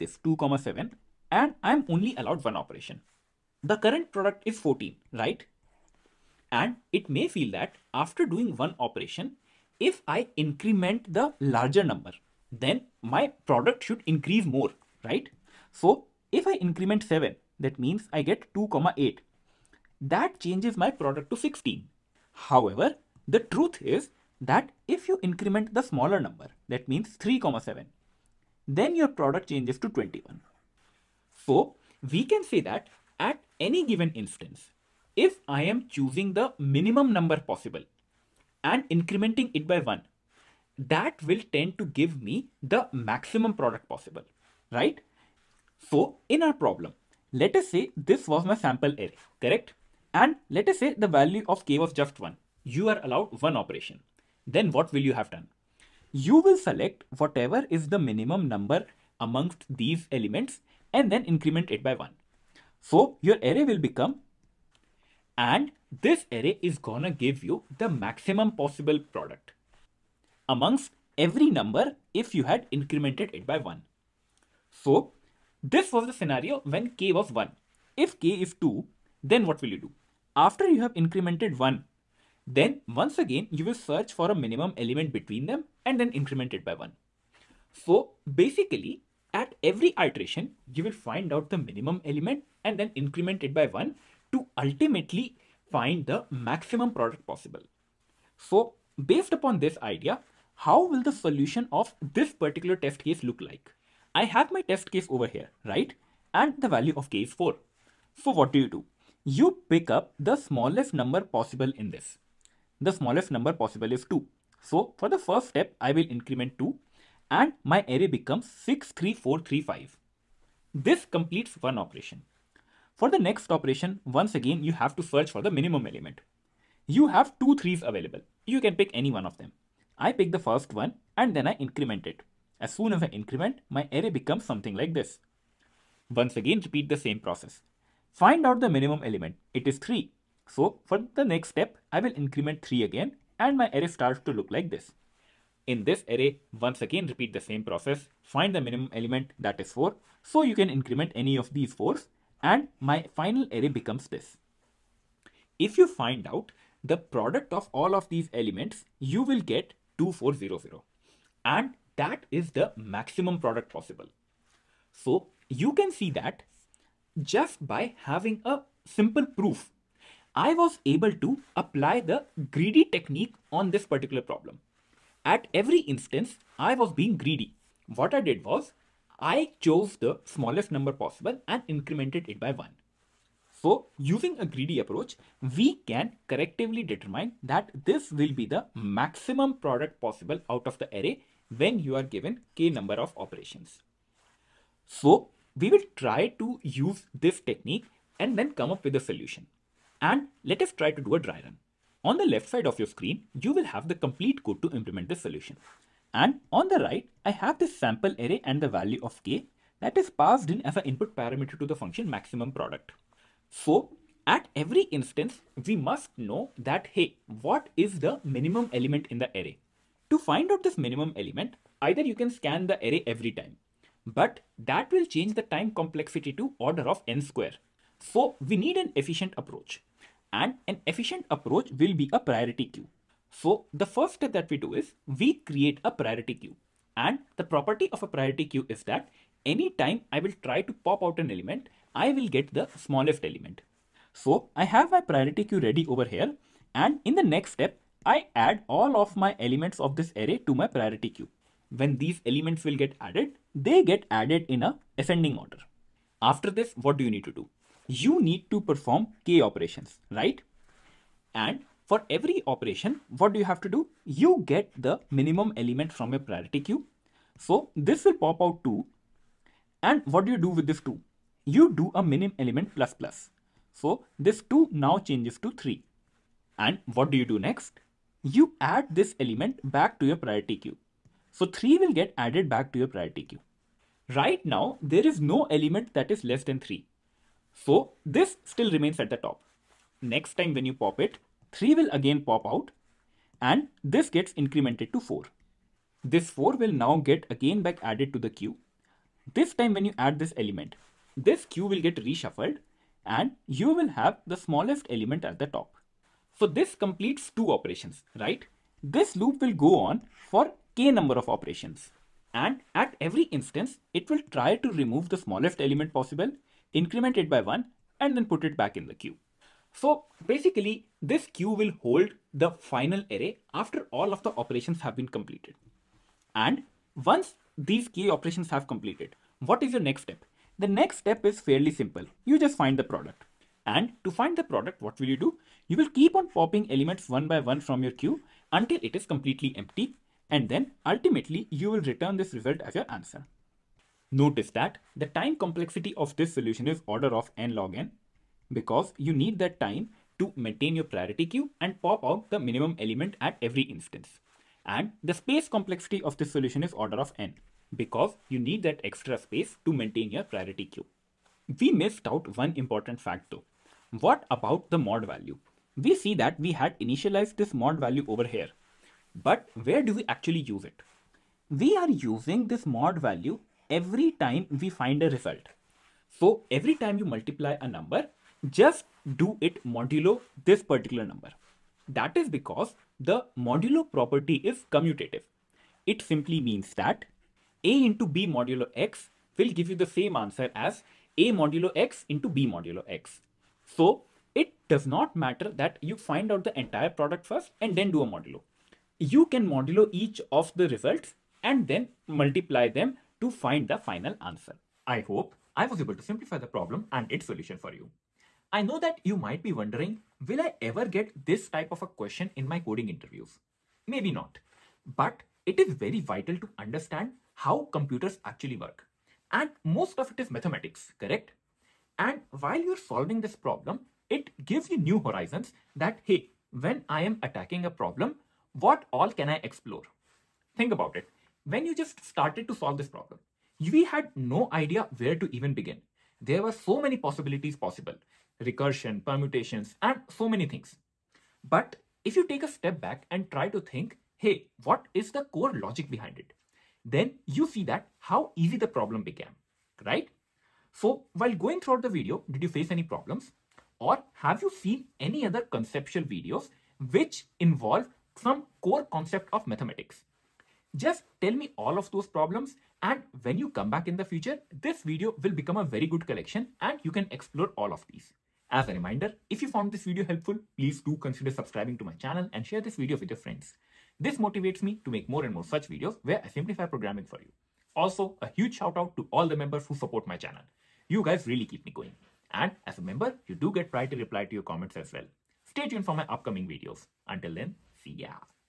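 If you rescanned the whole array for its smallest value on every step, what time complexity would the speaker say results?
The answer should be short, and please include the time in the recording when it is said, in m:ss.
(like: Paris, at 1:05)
order of n square, at 3:46.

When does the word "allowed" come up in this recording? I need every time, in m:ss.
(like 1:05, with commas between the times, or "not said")
0:02, 0:53.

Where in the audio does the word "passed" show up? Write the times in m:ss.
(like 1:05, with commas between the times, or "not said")
3:30.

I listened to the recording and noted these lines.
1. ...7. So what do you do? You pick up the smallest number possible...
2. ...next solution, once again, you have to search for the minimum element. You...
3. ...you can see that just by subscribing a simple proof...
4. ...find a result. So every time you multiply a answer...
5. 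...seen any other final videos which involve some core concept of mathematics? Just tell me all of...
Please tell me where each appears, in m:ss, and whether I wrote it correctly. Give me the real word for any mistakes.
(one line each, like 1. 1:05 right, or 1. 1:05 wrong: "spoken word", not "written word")
1. 1:47 wrong: "4", not "7"
2. 2:03 wrong: "operation", not "solution"
3. 2:45 wrong: "having", not "subscribing"
4. 6:14 wrong: "number", not "answer"
5. 7:34 wrong: "conceptual", not "final".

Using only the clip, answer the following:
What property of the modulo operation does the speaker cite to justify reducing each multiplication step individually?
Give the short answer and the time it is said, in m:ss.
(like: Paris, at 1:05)
commutative, at 6:24.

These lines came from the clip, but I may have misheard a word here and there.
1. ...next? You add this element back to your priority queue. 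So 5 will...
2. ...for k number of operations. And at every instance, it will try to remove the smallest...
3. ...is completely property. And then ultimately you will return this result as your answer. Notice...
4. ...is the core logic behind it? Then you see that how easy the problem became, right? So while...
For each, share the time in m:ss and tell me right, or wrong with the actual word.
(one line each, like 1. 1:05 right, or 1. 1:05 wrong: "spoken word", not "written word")
1. 4:37 wrong: "3", not "5"
2. 5:10 right
3. 5:38 wrong: "empty", not "property"
4. 7:24 right.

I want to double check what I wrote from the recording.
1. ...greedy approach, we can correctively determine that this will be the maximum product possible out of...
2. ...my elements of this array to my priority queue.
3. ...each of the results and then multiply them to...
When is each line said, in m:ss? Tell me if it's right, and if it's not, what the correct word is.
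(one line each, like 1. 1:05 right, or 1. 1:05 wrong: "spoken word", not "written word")
1. 3:04 right
2. 4:09 right
3. 6:39 right.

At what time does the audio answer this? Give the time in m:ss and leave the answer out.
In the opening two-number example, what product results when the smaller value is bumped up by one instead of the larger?
0:29.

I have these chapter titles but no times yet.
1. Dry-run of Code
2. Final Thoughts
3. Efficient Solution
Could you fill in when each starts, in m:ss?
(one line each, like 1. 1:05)
1. 3:21
2. 6:49
3. 1:44.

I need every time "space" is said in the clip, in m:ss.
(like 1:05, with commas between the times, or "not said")
5:55, 5:59.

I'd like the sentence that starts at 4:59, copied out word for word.
This time when you add this element, this queue will get reshuffled and you will have the smallest element at the top.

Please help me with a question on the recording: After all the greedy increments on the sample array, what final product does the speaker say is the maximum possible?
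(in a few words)
2400.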